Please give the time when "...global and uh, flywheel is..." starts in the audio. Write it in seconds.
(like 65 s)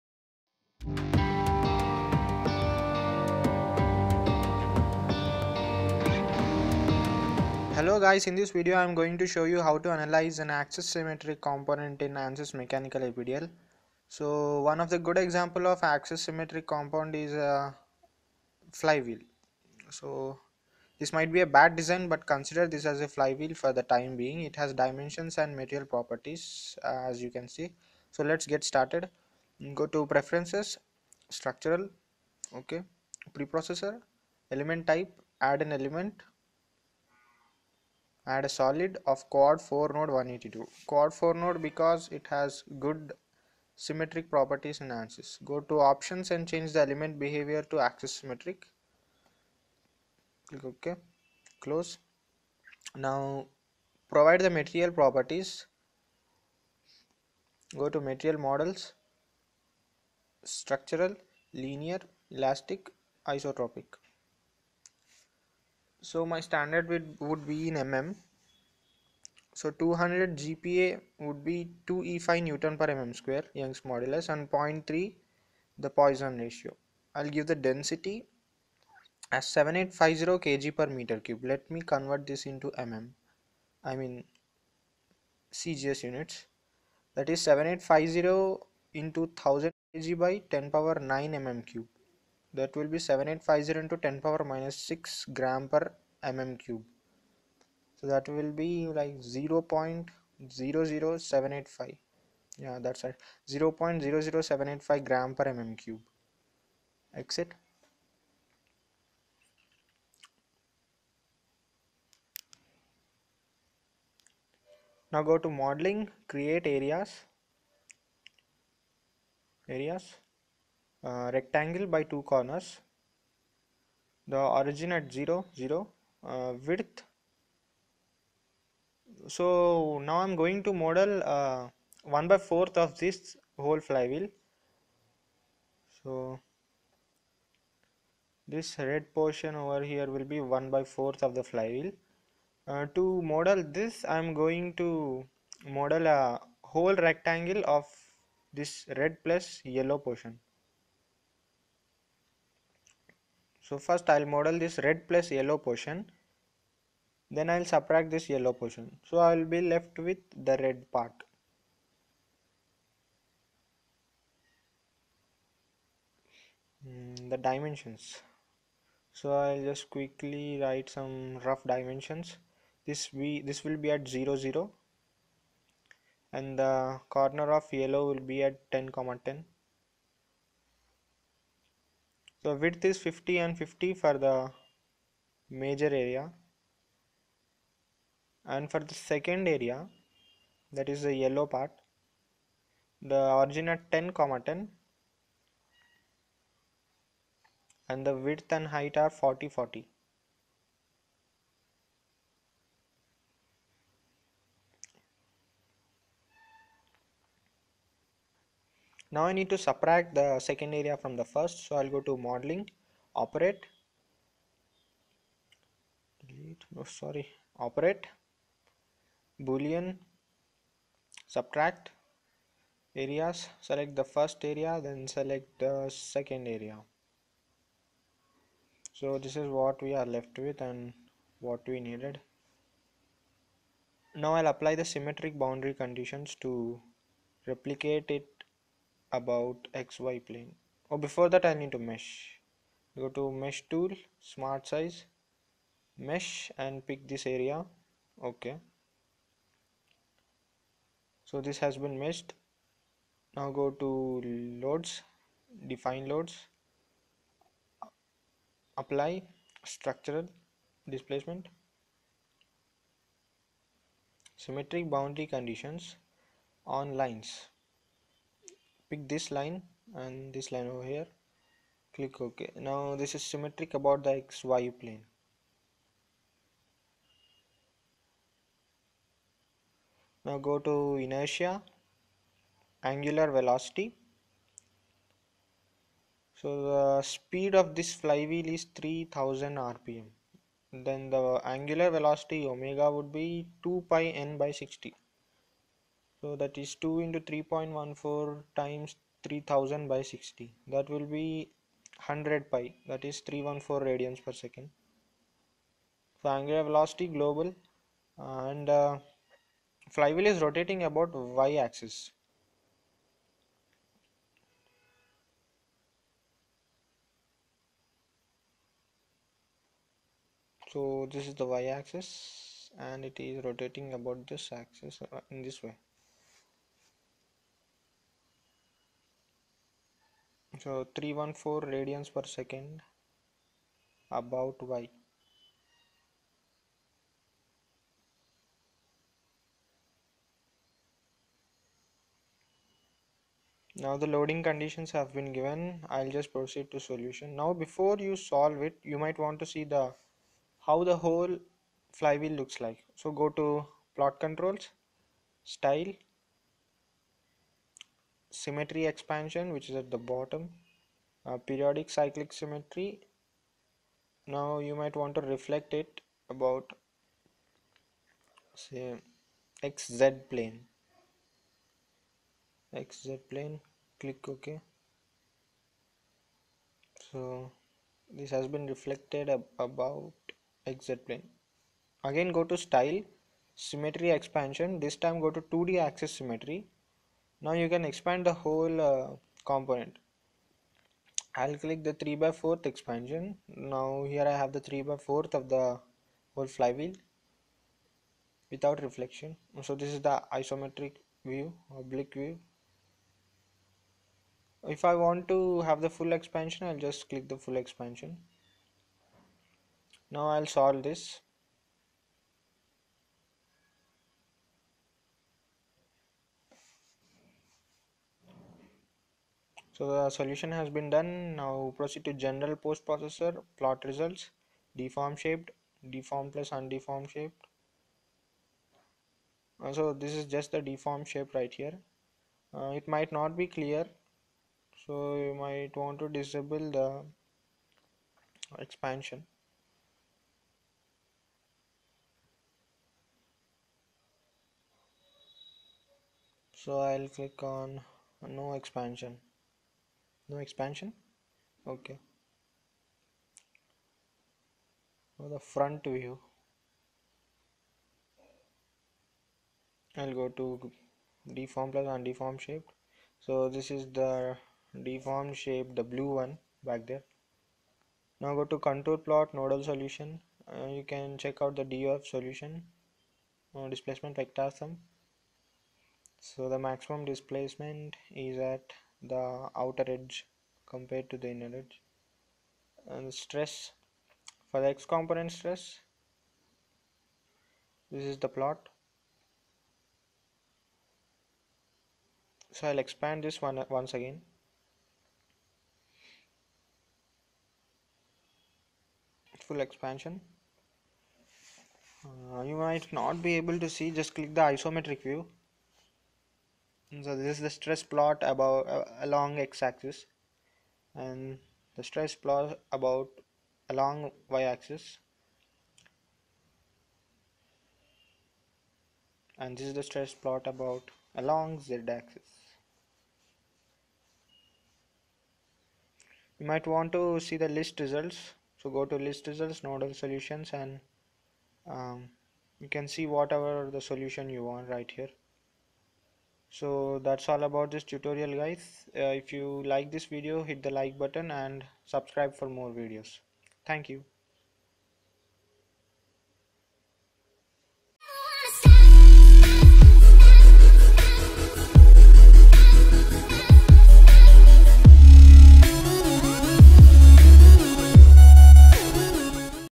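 307 s.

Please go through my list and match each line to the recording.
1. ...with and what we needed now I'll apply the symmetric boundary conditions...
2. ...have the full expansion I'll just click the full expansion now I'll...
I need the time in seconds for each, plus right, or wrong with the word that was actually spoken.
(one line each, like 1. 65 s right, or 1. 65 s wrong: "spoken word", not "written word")
1. 230 s right
2. 405 s right.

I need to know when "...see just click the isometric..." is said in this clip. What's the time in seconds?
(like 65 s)
503 s.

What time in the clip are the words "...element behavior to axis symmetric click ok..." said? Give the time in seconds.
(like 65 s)
46 s.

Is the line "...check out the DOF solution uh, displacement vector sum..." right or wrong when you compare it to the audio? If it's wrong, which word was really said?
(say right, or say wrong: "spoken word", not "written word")
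right.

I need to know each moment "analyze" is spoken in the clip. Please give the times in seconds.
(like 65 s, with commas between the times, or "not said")
9 s.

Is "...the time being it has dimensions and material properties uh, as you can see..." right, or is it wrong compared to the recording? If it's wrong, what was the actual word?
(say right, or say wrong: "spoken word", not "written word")
right.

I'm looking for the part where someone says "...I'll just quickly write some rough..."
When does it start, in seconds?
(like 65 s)
169 s.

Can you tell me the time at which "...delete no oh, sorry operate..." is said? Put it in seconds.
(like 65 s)
216 s.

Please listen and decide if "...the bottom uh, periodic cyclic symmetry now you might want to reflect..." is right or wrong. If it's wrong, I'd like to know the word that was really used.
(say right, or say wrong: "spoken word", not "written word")
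right.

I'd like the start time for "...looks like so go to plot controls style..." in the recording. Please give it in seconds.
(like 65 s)
352 s.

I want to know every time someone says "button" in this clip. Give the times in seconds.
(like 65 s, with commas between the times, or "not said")
540 s.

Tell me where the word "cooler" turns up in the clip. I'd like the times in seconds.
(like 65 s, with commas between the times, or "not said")
not said.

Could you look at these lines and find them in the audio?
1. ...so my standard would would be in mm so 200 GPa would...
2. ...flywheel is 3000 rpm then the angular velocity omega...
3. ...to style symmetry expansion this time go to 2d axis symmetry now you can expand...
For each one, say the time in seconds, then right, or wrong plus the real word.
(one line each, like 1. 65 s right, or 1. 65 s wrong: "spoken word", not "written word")
1. 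66 s right
2. 288 s right
3. 382 s right.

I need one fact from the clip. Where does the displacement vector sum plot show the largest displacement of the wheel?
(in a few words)
Outer edge.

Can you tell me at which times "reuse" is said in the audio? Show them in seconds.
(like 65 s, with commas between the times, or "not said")
not said.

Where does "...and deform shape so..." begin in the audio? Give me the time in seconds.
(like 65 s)
461 s.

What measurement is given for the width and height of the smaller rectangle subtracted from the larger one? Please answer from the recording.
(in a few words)
40.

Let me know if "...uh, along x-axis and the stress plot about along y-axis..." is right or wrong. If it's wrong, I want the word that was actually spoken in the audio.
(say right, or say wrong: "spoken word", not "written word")
right.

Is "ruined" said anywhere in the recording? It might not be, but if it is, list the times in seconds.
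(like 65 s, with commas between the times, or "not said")
not said.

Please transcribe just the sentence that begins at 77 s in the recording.
I'll give the density as 7850 kg per meter cube.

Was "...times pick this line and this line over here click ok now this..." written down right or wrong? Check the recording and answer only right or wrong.
wrong.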